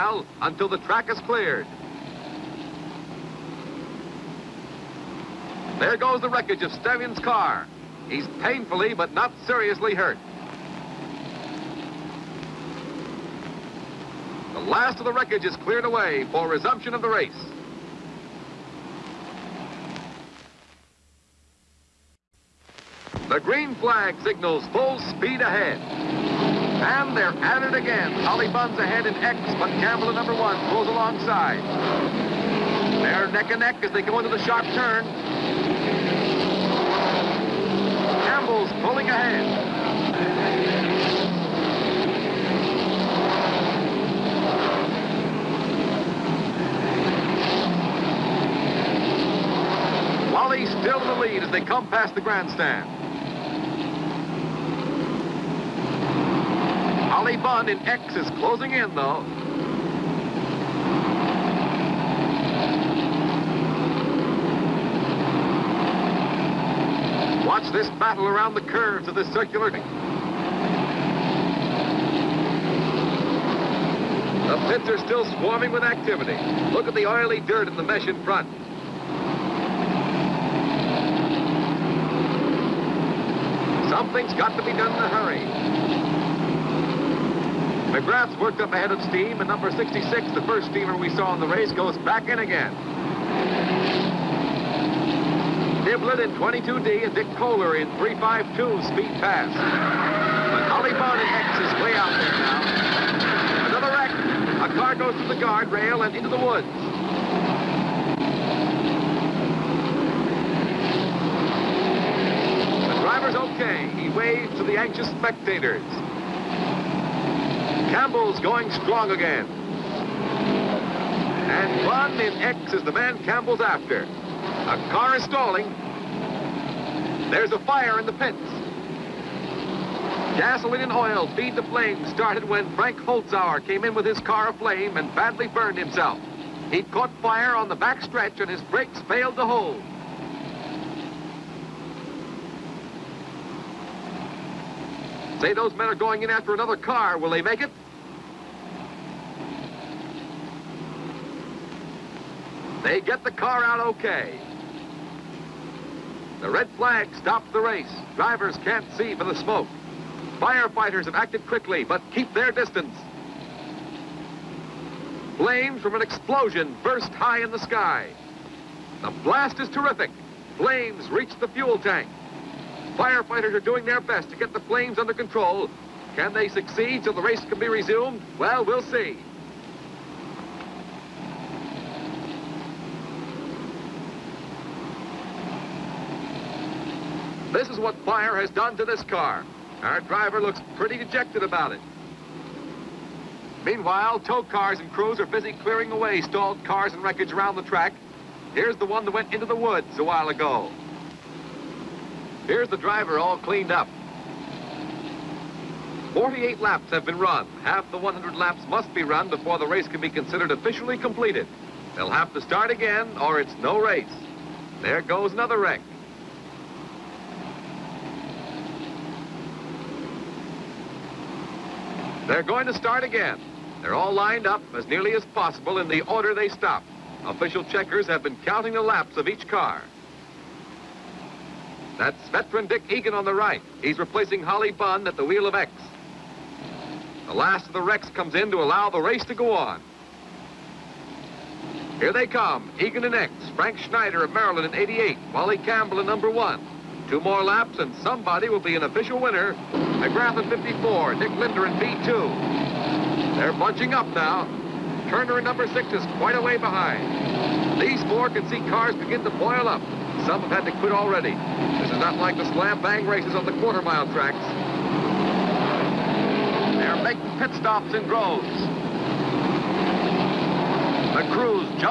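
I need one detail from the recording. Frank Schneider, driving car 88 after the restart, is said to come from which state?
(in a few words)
Maryland.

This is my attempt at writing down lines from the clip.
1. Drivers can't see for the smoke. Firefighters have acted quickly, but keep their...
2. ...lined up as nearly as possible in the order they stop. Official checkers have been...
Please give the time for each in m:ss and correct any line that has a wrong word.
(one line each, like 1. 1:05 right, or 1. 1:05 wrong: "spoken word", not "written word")
1. 2:38 right
2. 3:44 right.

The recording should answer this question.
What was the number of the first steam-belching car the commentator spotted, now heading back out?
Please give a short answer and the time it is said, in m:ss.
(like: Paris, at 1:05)
66, at 1:29.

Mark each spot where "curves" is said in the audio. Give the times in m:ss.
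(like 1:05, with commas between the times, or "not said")
1:08.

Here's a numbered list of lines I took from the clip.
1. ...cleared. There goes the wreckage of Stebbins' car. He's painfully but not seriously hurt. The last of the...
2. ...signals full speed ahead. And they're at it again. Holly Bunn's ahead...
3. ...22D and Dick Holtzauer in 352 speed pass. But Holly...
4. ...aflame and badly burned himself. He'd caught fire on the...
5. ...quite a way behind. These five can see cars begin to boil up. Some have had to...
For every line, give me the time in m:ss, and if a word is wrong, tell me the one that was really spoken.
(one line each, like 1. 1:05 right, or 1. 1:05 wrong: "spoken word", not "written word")
1. 0:01 right
2. 0:24 right
3. 1:36 wrong: "Kohler", not "Holtzauer"
4. 2:14 right
5. 4:16 wrong: "four", not "five".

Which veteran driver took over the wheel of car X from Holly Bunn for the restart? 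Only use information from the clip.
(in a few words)
Dick Egan.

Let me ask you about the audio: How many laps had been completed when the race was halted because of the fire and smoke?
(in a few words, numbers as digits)
48.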